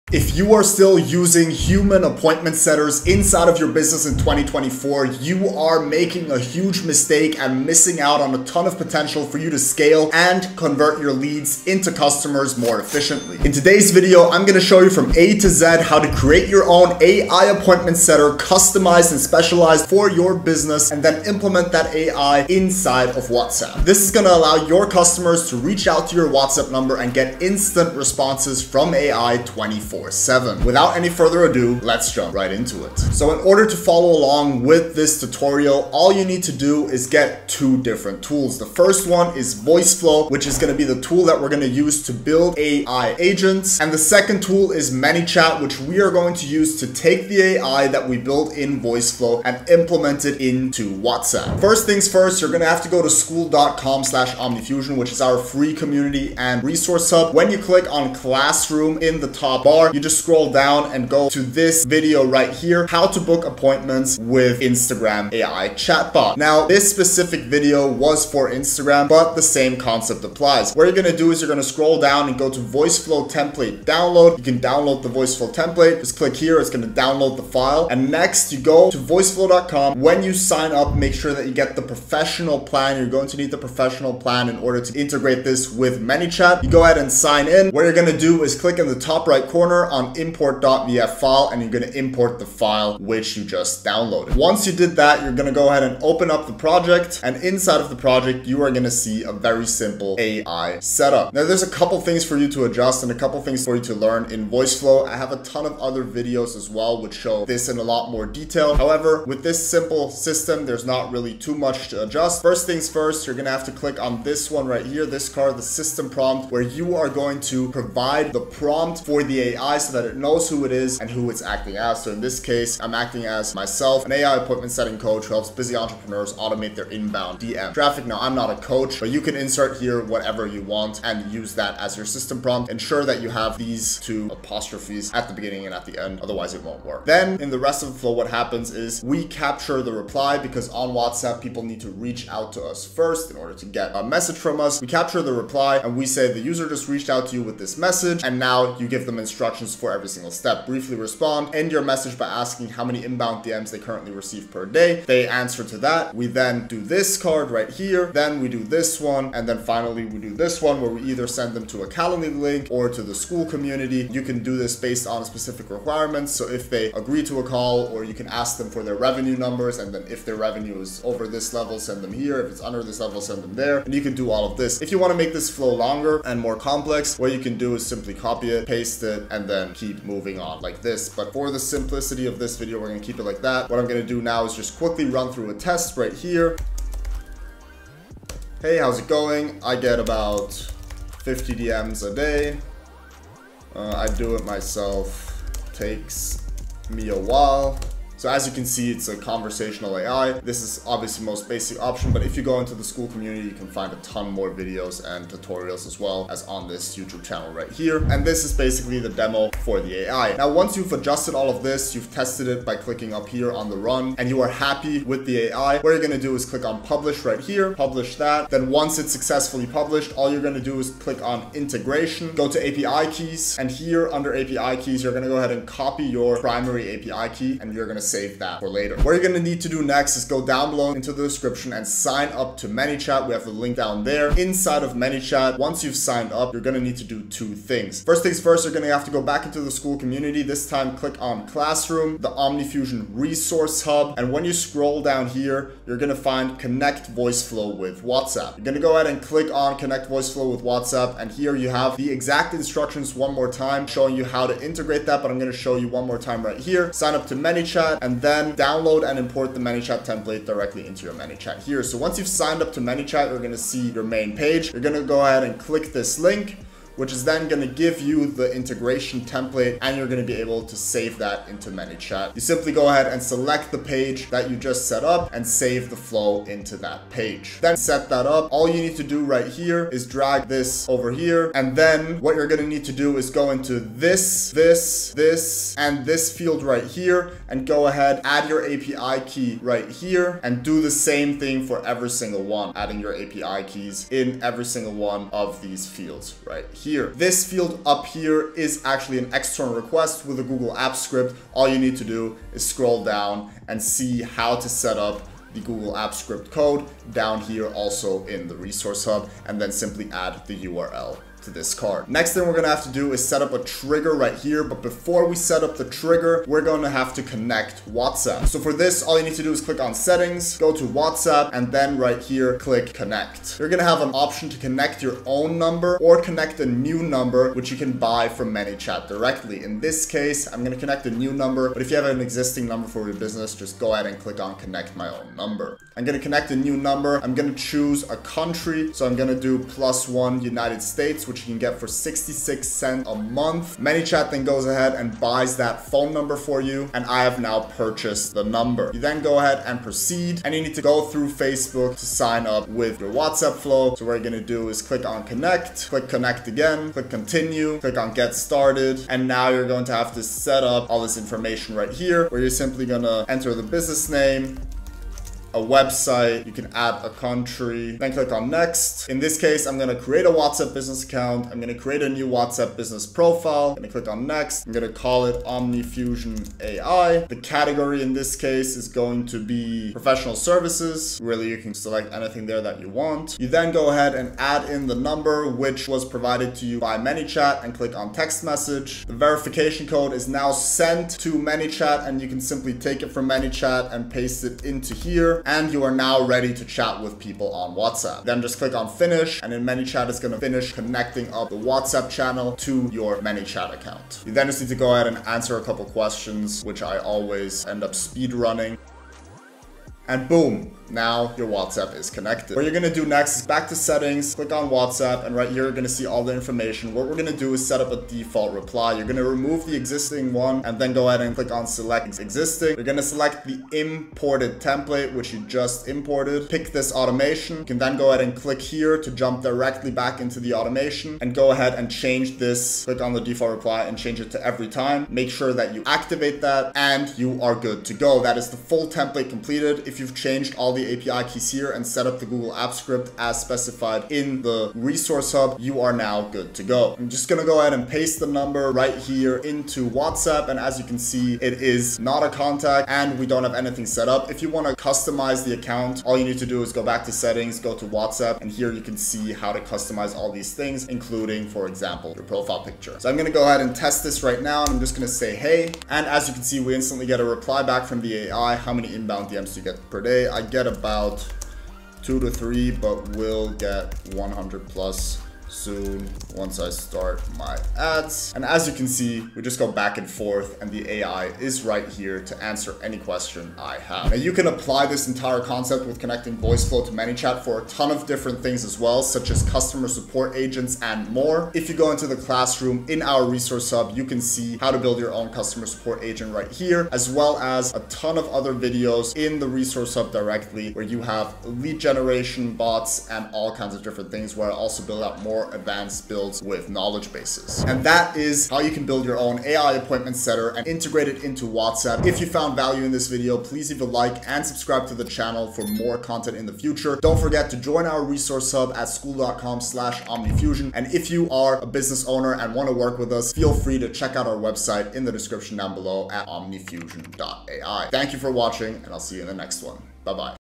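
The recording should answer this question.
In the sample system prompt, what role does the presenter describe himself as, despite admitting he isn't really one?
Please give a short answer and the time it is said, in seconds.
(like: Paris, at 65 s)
AI appointment setting coach, at 124 s.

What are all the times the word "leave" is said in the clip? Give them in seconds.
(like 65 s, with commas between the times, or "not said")
513 s.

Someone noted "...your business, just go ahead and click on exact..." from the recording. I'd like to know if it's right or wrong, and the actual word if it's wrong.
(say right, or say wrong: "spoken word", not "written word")
wrong: "connect", not "exact".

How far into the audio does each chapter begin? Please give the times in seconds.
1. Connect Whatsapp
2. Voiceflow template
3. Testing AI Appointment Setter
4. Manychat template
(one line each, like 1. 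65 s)
1. 315 s
2. 50 s
3. 445 s
4. 230 s.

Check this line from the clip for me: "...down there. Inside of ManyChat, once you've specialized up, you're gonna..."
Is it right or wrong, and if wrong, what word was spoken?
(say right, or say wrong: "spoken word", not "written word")
wrong: "signed", not "specialized".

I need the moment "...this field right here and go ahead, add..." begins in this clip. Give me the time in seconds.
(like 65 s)
286 s.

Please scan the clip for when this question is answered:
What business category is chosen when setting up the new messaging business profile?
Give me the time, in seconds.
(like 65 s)
379 s.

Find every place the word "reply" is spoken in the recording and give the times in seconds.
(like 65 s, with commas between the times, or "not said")
139 s, 145 s, 418 s, 433 s, 467 s.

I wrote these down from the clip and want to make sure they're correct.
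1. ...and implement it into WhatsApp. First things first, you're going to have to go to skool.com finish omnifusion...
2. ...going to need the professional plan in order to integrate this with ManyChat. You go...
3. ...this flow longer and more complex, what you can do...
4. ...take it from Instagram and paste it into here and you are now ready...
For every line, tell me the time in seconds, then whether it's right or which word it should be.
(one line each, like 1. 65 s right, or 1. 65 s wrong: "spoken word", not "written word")
1. 49 s wrong: "slash", not "finish"
2. 83 s right
3. 175 s right
4. 392 s wrong: "ManyChat", not "Instagram".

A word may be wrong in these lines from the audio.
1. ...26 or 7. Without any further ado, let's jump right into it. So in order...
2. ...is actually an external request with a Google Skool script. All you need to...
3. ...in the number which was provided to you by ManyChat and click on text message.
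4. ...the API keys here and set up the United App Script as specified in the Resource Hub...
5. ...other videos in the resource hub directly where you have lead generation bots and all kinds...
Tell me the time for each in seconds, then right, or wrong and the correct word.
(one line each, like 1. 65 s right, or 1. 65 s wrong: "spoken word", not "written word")
1. 29 s wrong: "24", not "26"
2. 298 s wrong: "Apps", not "Skool"
3. 384 s right
4. 440 s wrong: "Google", not "United"
5. 498 s right.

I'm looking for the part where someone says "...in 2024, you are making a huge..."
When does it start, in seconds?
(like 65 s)
4 s.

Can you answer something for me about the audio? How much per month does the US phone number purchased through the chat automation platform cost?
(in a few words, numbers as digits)
66 cents.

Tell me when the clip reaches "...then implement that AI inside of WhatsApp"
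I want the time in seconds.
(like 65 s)
21 s.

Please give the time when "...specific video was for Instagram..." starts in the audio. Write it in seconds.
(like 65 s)
66 s.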